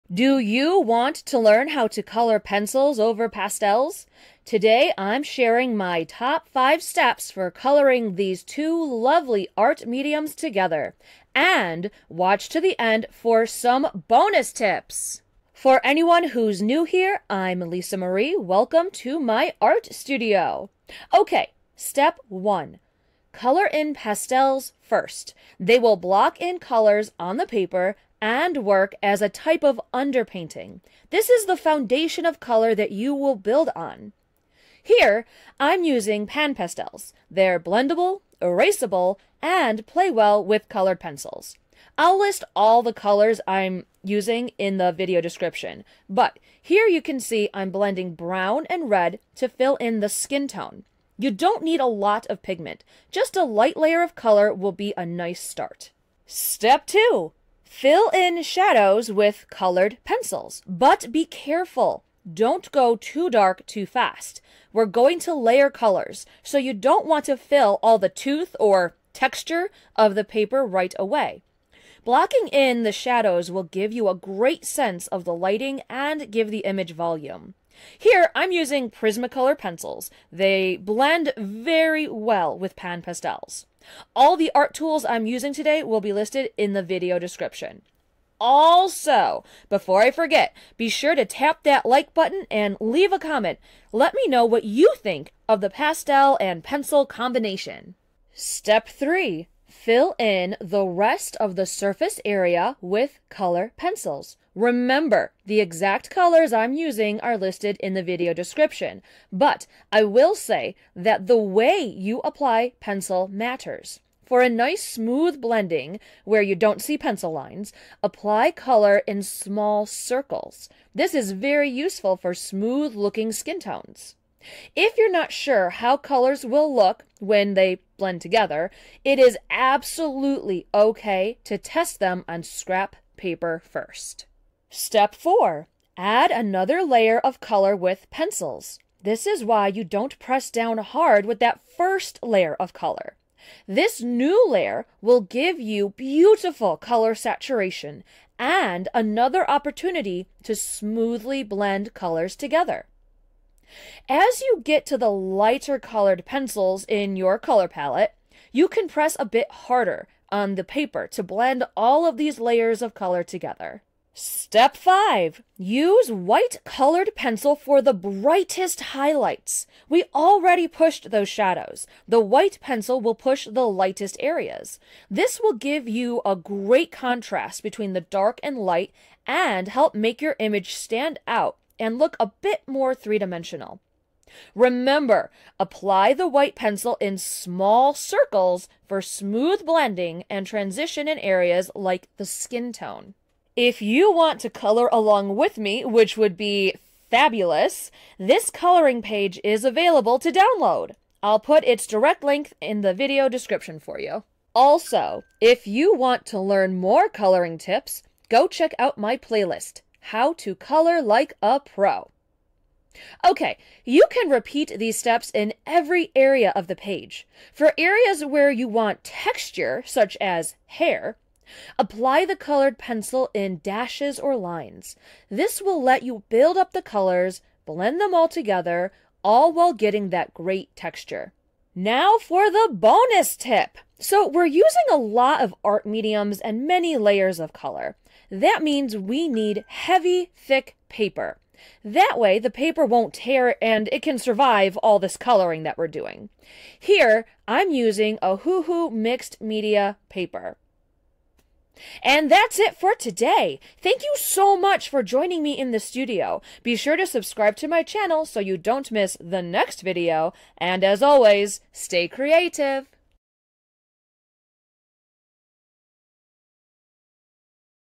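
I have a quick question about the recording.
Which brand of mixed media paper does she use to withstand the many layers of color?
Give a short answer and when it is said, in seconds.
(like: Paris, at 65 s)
Ohuhu, at 248 s.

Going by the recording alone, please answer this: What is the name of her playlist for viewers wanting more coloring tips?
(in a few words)
How to Color Like a Pro.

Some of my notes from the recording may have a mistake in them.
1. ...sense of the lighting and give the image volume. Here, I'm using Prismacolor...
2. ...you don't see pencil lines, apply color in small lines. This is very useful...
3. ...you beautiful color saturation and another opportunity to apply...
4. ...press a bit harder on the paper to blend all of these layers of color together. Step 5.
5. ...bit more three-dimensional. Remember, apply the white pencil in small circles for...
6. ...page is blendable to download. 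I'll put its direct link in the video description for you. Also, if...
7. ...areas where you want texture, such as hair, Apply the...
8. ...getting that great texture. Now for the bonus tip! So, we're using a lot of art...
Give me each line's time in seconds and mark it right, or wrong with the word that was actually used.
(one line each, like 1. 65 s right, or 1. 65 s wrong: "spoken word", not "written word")
1. 74 s right
2. 116 s wrong: "circles", not "lines"
3. 145 s wrong: "smoothly", not "apply"
4. 158 s right
5. 182 s right
6. 199 s wrong: "available", not "blendable"
7. 217 s right
8. 229 s right.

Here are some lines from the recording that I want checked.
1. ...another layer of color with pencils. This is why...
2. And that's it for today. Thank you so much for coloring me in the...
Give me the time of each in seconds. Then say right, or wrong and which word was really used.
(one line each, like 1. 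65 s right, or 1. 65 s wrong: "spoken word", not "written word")
1. 136 s right
2. 252 s wrong: "joining", not "coloring".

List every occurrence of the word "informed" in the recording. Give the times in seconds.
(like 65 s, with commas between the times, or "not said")
not said.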